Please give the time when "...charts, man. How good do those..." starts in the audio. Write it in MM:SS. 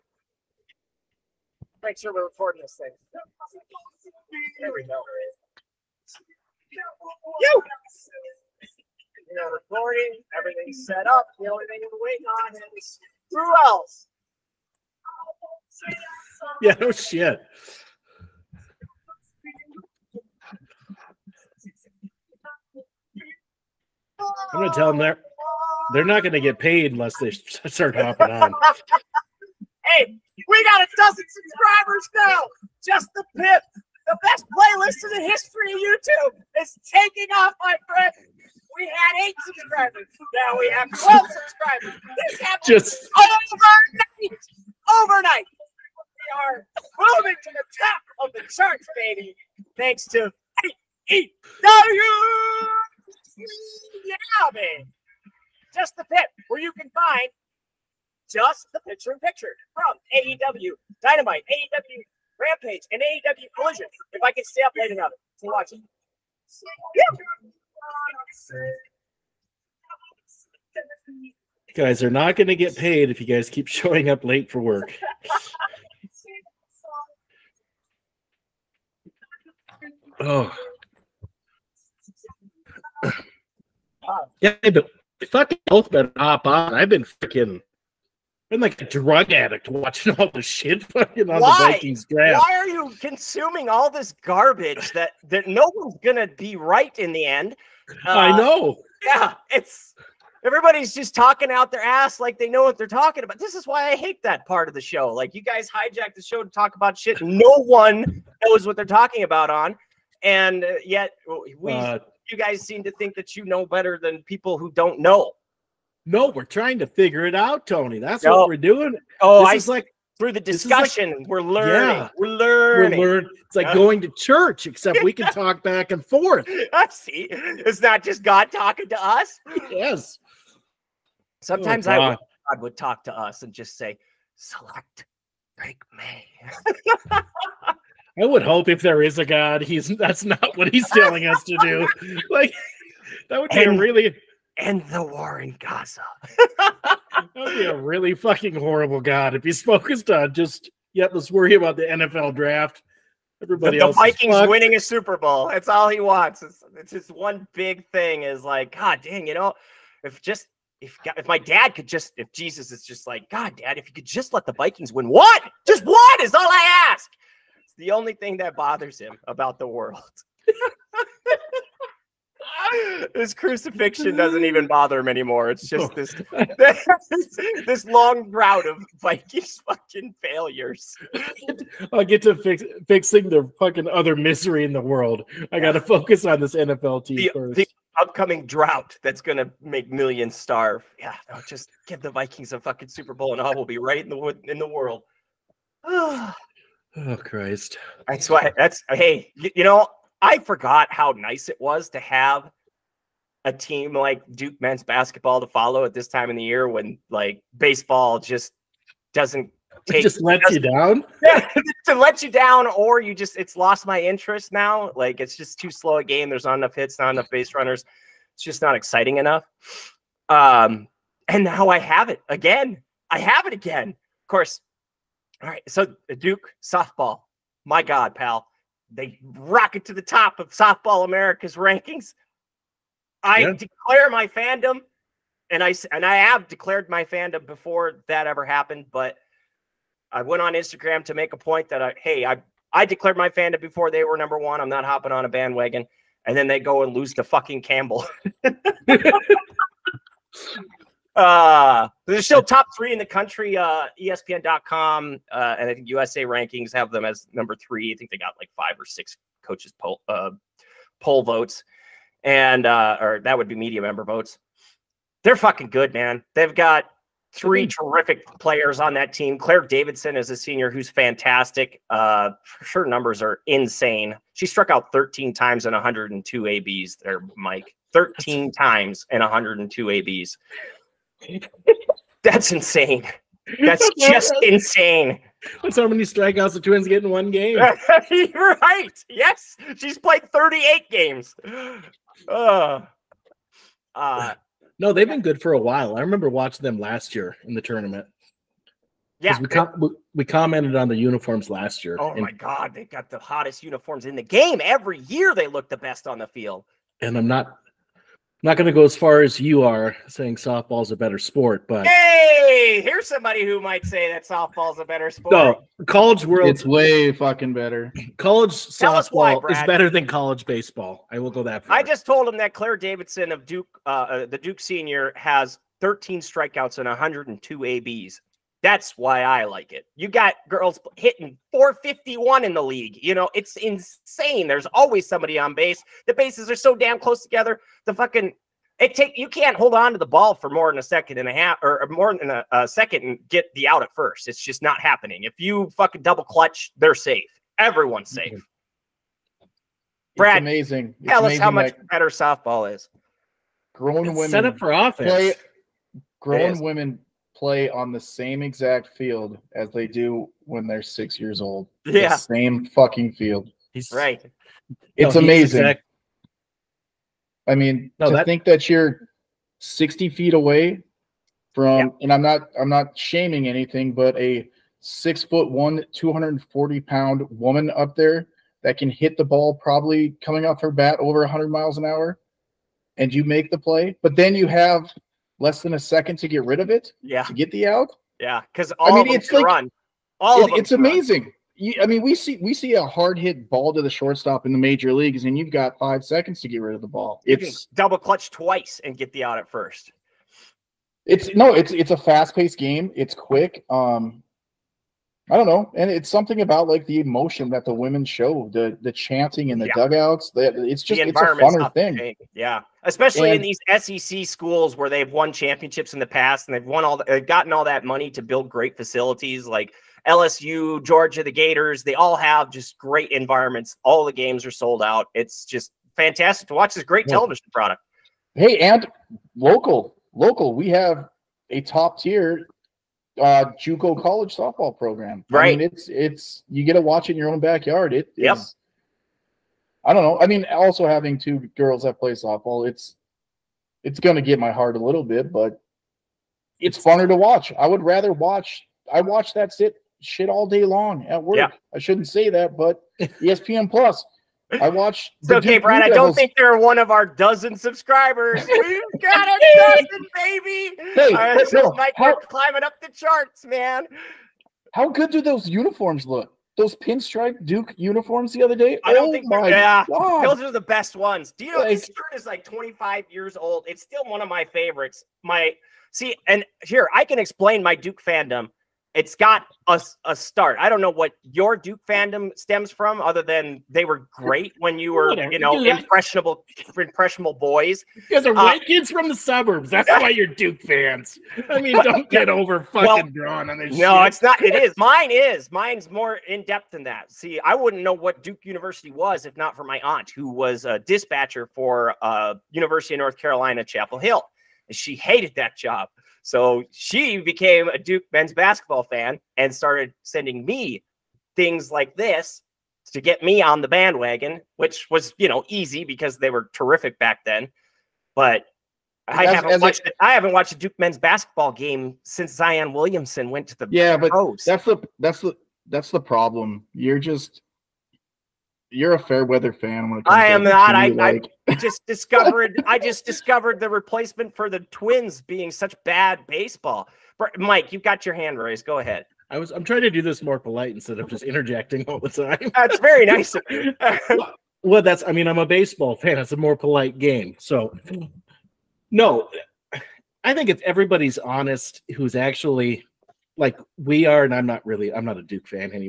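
07:42.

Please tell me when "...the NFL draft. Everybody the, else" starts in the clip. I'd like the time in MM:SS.
02:31.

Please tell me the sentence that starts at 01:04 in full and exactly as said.
If I can stay up late enough to watch it.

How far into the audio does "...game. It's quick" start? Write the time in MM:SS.
06:42.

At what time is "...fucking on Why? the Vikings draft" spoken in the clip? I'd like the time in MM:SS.
01:30.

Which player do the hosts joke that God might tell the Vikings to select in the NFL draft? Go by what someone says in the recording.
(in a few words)
Drake Maye.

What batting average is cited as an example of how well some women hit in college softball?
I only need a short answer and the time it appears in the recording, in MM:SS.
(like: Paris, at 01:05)
451, at 05:31.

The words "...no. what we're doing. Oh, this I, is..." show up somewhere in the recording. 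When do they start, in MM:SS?
01:58.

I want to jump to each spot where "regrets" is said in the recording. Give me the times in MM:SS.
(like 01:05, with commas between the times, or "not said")
not said.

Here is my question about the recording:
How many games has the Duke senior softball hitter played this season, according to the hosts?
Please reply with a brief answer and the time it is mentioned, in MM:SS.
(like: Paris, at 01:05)
38, at 04:50.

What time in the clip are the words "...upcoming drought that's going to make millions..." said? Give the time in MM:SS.
03:08.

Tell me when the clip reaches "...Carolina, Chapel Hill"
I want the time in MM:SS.
08:23.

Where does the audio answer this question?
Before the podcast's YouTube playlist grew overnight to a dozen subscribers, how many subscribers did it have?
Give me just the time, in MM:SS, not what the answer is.
00:39.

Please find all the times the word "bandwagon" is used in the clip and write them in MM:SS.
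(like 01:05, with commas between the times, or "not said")
04:05, 08:33.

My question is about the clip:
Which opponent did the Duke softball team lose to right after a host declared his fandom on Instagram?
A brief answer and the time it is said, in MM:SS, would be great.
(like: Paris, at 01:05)
Campbell, at 04:07.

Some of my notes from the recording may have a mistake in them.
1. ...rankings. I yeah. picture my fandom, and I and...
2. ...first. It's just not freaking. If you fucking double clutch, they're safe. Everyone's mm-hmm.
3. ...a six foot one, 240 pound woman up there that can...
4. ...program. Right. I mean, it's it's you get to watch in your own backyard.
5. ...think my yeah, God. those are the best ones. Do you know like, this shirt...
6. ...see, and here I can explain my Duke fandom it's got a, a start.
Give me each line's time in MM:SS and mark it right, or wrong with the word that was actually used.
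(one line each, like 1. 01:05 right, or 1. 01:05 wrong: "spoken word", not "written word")
1. 03:51 wrong: "declare", not "picture"
2. 05:43 wrong: "happening", not "freaking"
3. 06:14 right
4. 07:14 right
5. 07:49 right
6. 07:55 right.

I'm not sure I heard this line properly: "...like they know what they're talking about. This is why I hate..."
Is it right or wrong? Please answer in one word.
right.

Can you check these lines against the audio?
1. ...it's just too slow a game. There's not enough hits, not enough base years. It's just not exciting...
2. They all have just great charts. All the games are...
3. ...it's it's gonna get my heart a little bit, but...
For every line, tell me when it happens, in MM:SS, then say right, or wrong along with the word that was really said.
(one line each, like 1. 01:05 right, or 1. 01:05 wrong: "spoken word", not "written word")
1. 03:35 wrong: "runners", not "years"
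2. 07:01 wrong: "environments", not "charts"
3. 07:22 right.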